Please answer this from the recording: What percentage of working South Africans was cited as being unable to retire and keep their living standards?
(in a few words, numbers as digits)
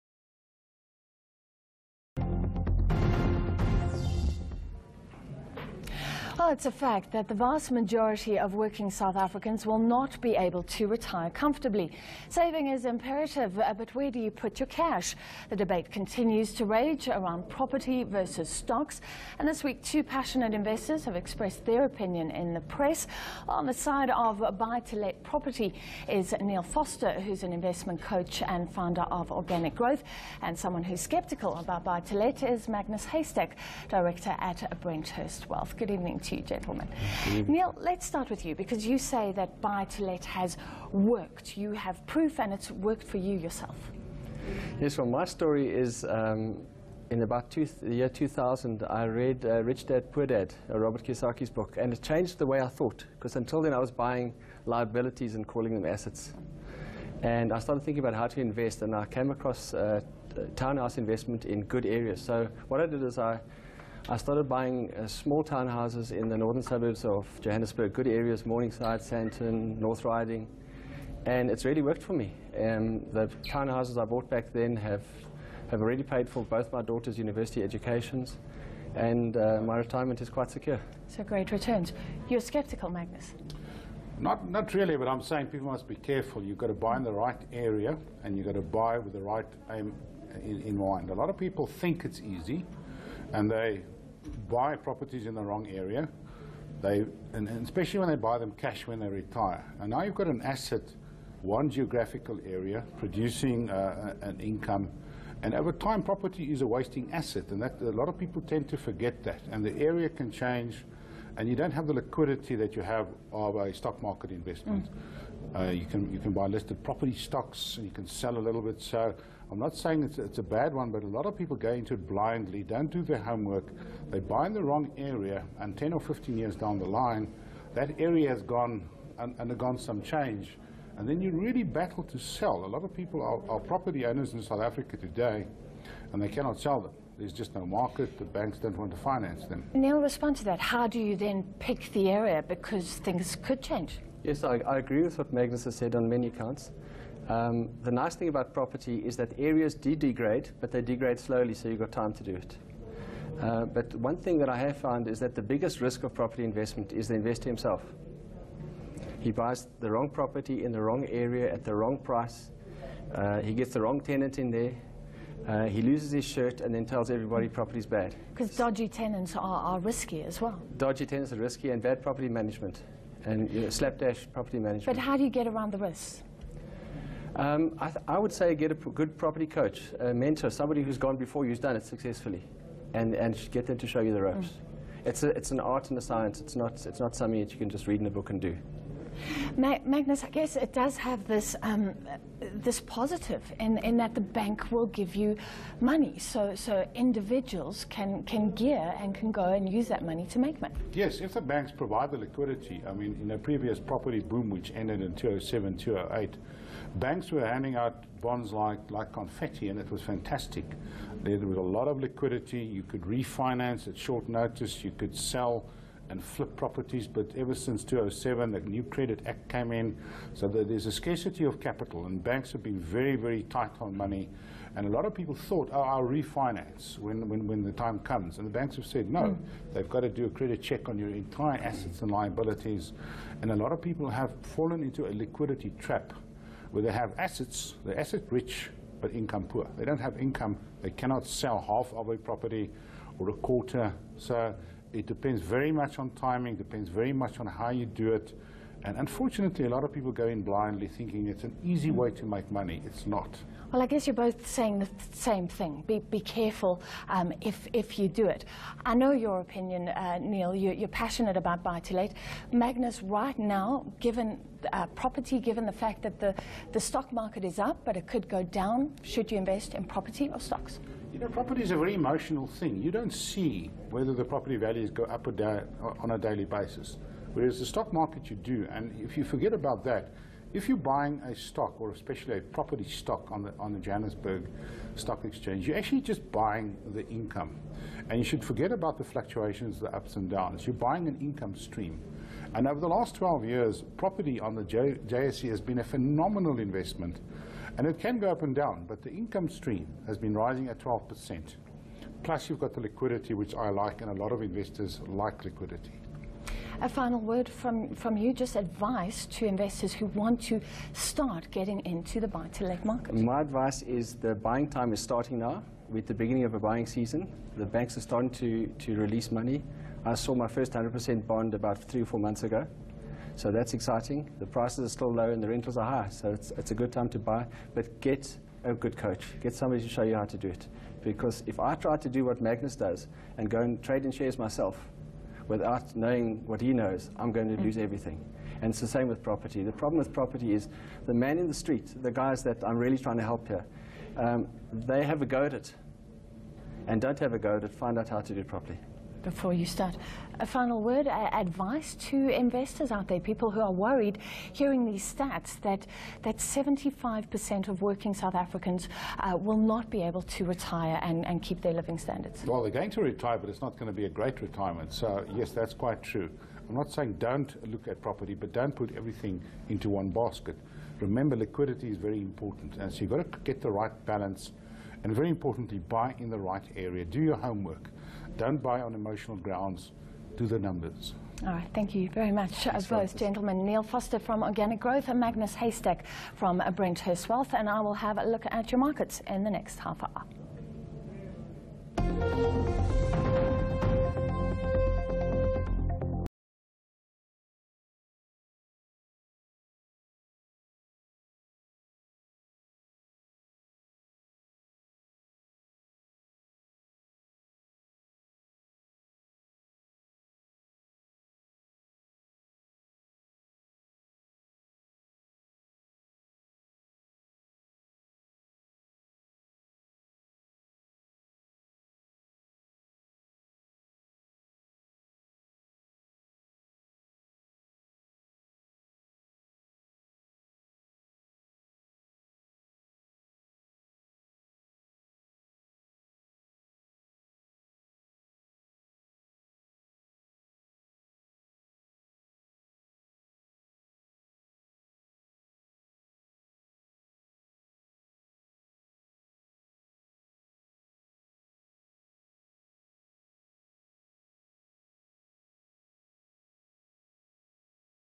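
75%.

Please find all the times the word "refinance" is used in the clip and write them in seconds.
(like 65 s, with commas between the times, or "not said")
213 s, 226 s.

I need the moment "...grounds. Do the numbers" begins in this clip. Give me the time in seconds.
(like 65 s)
379 s.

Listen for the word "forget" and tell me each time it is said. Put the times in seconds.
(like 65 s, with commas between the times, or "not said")
108 s, 279 s, 288 s.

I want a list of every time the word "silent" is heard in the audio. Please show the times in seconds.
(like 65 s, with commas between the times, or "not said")
not said.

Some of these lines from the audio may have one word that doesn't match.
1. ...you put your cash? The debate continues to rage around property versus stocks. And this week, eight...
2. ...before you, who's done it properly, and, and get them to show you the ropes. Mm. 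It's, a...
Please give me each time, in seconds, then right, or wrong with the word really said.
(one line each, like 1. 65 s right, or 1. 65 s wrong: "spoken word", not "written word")
1. 14 s wrong: "two", not "eight"
2. 181 s wrong: "successfully", not "properly".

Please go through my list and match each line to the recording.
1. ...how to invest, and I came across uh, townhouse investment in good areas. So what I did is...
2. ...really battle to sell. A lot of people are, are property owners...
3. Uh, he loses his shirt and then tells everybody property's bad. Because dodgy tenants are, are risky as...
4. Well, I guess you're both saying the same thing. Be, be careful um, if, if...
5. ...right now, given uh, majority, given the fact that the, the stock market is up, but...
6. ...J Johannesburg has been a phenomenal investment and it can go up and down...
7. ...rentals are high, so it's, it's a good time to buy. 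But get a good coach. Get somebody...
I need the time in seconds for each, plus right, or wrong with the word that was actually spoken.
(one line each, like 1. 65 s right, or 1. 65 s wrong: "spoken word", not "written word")
1. 58 s right
2. 131 s right
3. 165 s right
4. 253 s right
5. 263 s wrong: "property", not "majority"
6. 294 s wrong: "JSE", not "Johannesburg"
7. 325 s right.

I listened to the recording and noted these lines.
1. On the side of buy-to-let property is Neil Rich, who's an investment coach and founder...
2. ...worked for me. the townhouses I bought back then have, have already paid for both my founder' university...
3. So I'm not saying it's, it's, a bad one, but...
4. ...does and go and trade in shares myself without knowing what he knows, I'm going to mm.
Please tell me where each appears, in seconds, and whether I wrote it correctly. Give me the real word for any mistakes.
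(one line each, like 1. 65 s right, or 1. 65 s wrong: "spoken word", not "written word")
1. 23 s wrong: "Vorster", not "Rich"
2. 71 s wrong: "daughters", not "founder"
3. 118 s right
4. 332 s right.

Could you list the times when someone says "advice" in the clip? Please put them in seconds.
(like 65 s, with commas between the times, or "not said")
308 s, 313 s, 351 s.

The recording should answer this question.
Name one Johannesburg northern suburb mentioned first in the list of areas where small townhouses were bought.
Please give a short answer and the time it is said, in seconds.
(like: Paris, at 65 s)
Morningside, at 68 s.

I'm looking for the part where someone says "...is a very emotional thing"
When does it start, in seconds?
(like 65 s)
271 s.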